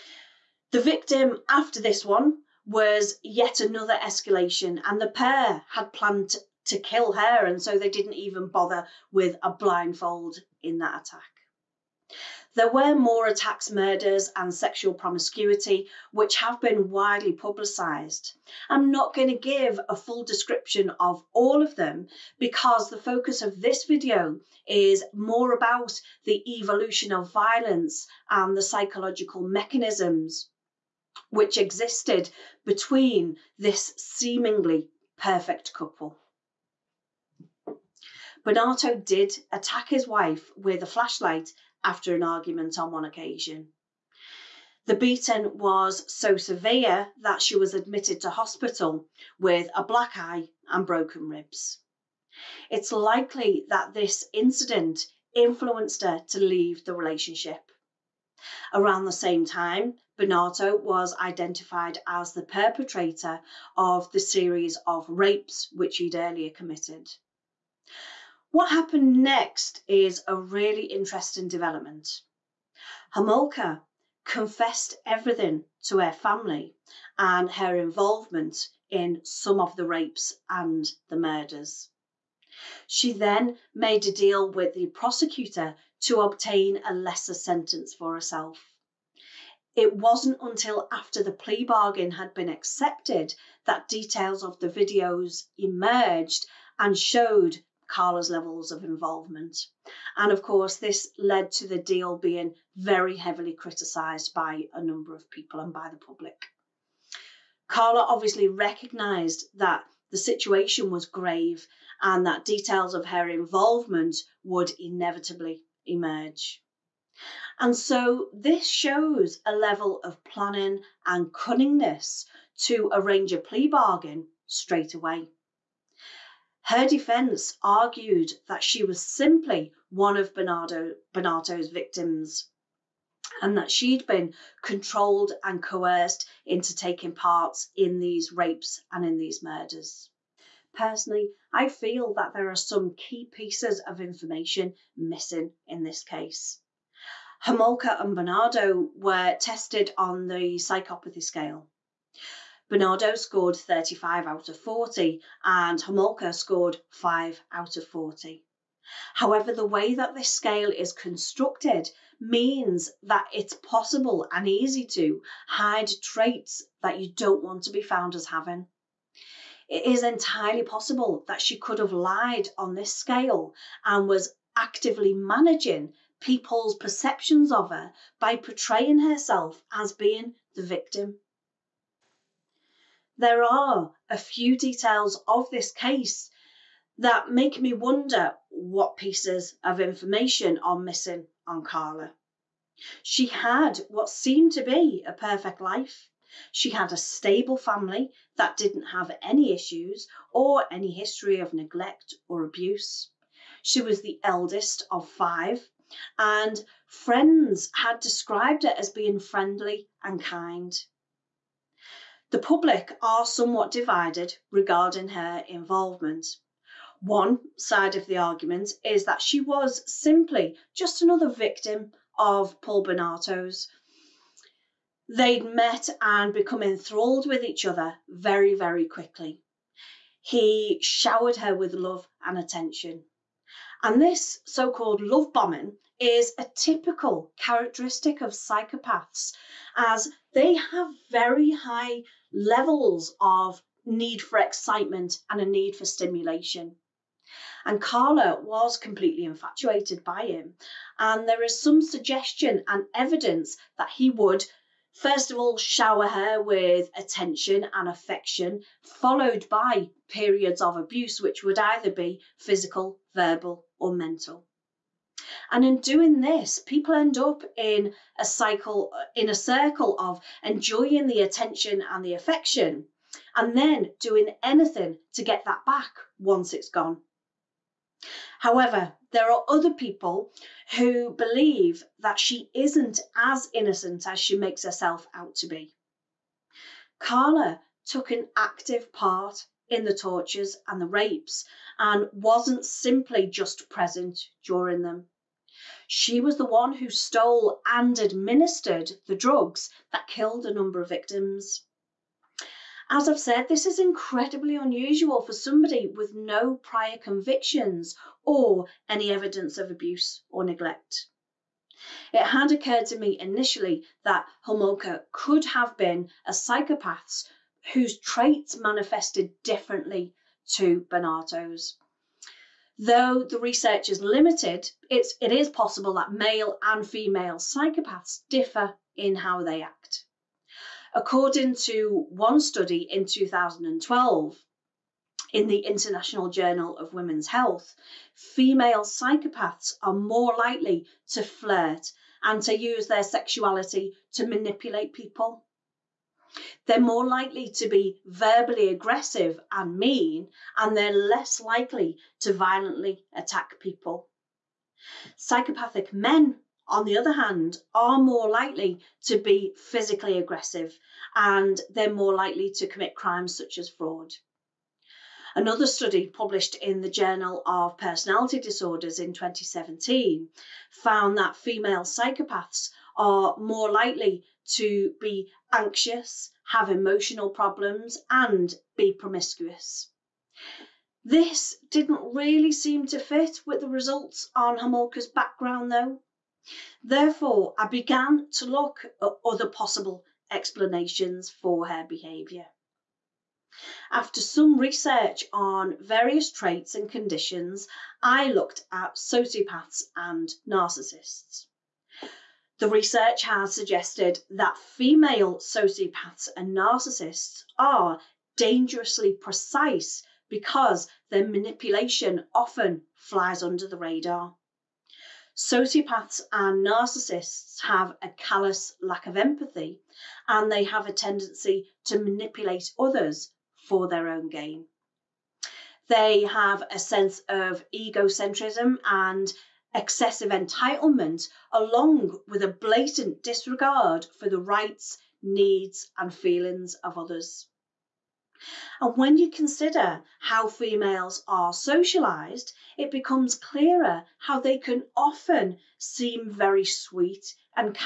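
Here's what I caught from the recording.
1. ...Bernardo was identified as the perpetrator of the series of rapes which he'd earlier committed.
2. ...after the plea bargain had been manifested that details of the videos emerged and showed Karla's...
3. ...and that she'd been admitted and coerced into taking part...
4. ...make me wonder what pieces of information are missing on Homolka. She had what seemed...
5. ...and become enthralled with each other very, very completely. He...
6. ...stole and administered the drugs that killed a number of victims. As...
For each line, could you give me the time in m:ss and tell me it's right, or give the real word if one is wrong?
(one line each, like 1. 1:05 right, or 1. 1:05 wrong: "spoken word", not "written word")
1. 1:00 right
2. 1:30 wrong: "accepted", not "manifested"
3. 2:13 wrong: "controlled", not "admitted"
4. 3:07 wrong: "Karla", not "Homolka"
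5. 3:45 wrong: "quickly", not "completely"
6. 4:56 right.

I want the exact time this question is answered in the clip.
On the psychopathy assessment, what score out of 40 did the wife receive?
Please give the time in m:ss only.
2:36.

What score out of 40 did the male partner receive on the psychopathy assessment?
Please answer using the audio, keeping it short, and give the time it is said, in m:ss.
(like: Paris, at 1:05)
35, at 2:33.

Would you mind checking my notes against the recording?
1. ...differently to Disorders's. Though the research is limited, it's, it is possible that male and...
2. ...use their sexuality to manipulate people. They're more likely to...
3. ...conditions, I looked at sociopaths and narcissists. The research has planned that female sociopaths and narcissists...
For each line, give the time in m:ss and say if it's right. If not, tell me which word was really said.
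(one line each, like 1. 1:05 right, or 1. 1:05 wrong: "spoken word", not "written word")
1. 5:19 wrong: "Bernardo", not "Disorders"
2. 5:42 right
3. 6:36 wrong: "suggested", not "planned".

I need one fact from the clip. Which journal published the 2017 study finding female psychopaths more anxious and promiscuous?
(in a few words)
Journal of Personality Disorders.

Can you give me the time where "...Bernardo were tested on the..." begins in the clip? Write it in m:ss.
2:28.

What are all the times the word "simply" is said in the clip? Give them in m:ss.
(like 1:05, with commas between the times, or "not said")
2:09, 3:39, 4:52.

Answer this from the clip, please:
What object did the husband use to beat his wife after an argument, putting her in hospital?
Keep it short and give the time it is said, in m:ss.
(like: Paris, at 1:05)
Flashlight, at 0:40.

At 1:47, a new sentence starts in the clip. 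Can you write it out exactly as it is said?
Karla obviously recognised that the situation was grave and that details of her involvement would inevitably emerge.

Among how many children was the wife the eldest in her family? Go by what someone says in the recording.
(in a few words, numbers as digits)
5.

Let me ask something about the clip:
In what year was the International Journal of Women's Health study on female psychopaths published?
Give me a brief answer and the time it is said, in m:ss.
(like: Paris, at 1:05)
2012, at 5:33.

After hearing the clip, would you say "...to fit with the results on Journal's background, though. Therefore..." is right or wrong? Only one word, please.
wrong.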